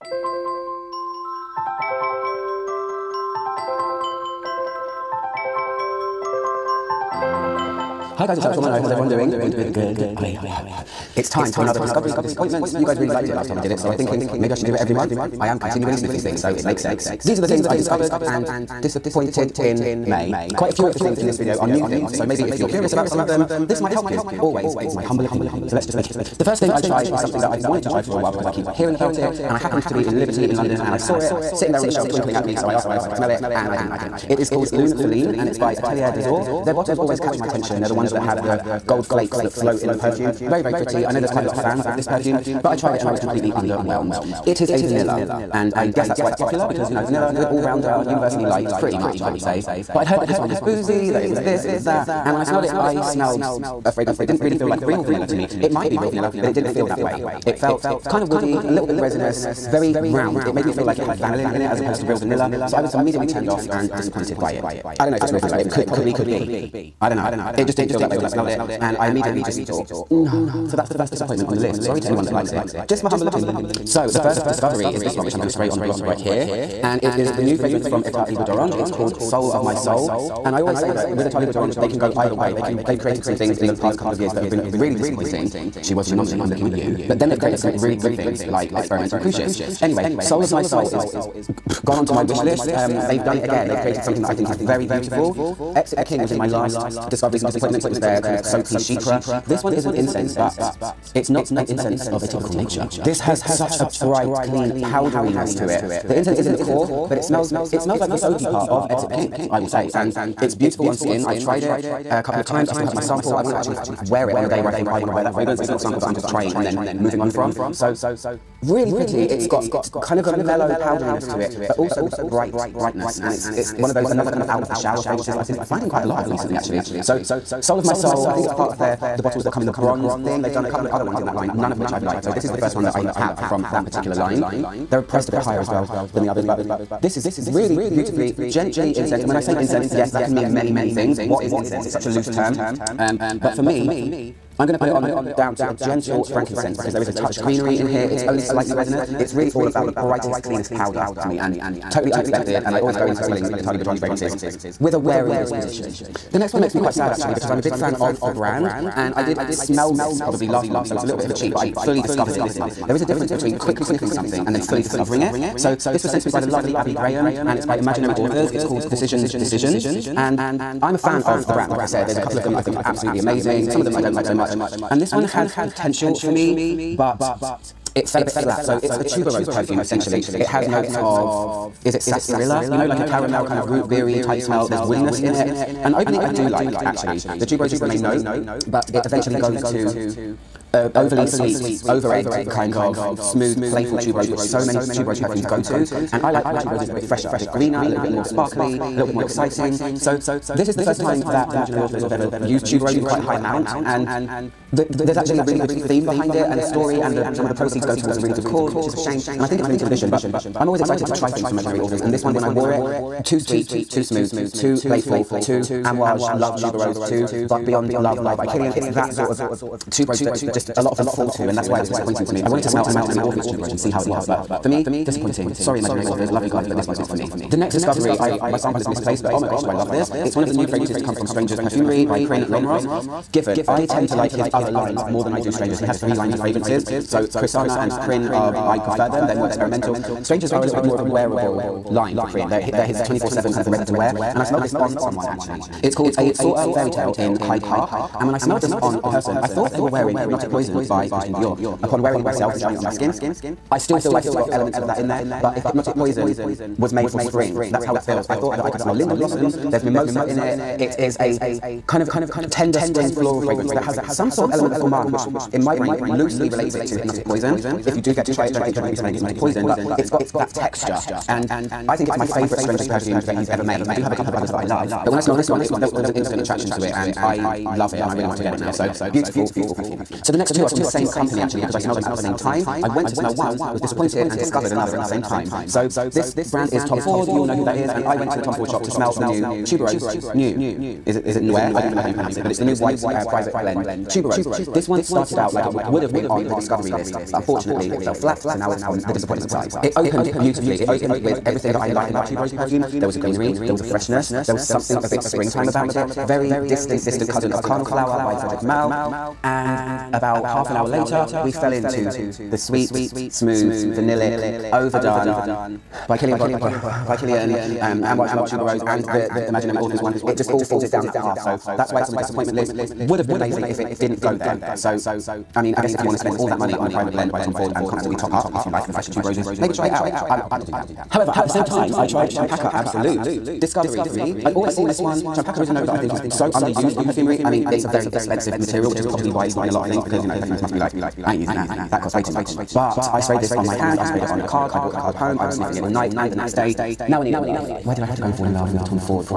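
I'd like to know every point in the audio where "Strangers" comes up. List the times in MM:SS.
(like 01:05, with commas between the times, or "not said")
03:51, 03:55, 04:00, 04:32.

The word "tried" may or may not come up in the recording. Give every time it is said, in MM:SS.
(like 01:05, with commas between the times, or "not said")
00:26, 00:42, 01:51, 05:32.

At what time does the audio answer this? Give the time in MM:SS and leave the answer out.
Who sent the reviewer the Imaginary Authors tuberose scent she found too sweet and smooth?
02:46.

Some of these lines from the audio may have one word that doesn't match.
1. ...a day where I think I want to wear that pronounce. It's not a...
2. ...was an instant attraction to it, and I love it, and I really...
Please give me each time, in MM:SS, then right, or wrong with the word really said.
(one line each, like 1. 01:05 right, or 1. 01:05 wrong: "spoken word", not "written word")
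1. 01:54 wrong: "fragrance", not "pronounce"
2. 04:36 right.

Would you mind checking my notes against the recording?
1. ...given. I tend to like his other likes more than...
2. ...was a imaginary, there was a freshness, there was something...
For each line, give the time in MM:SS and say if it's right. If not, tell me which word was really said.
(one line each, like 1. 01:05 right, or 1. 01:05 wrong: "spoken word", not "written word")
1. 03:53 wrong: "lines", not "likes"
2. 05:03 wrong: "greenery", not "imaginary".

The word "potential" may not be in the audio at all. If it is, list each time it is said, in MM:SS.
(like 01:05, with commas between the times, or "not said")
02:55.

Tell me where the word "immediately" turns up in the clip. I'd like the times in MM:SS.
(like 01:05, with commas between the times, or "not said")
01:02, 01:09.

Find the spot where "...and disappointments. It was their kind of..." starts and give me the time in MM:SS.
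01:37.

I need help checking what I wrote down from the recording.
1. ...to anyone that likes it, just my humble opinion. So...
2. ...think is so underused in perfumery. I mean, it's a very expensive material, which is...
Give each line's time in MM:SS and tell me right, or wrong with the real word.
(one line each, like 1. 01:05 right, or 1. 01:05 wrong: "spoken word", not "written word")
1. 01:12 right
2. 05:35 right.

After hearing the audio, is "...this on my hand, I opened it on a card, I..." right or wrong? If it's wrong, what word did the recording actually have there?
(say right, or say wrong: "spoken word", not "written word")
wrong: "sprayed", not "opened".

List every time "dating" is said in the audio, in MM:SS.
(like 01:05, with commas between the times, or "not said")
not said.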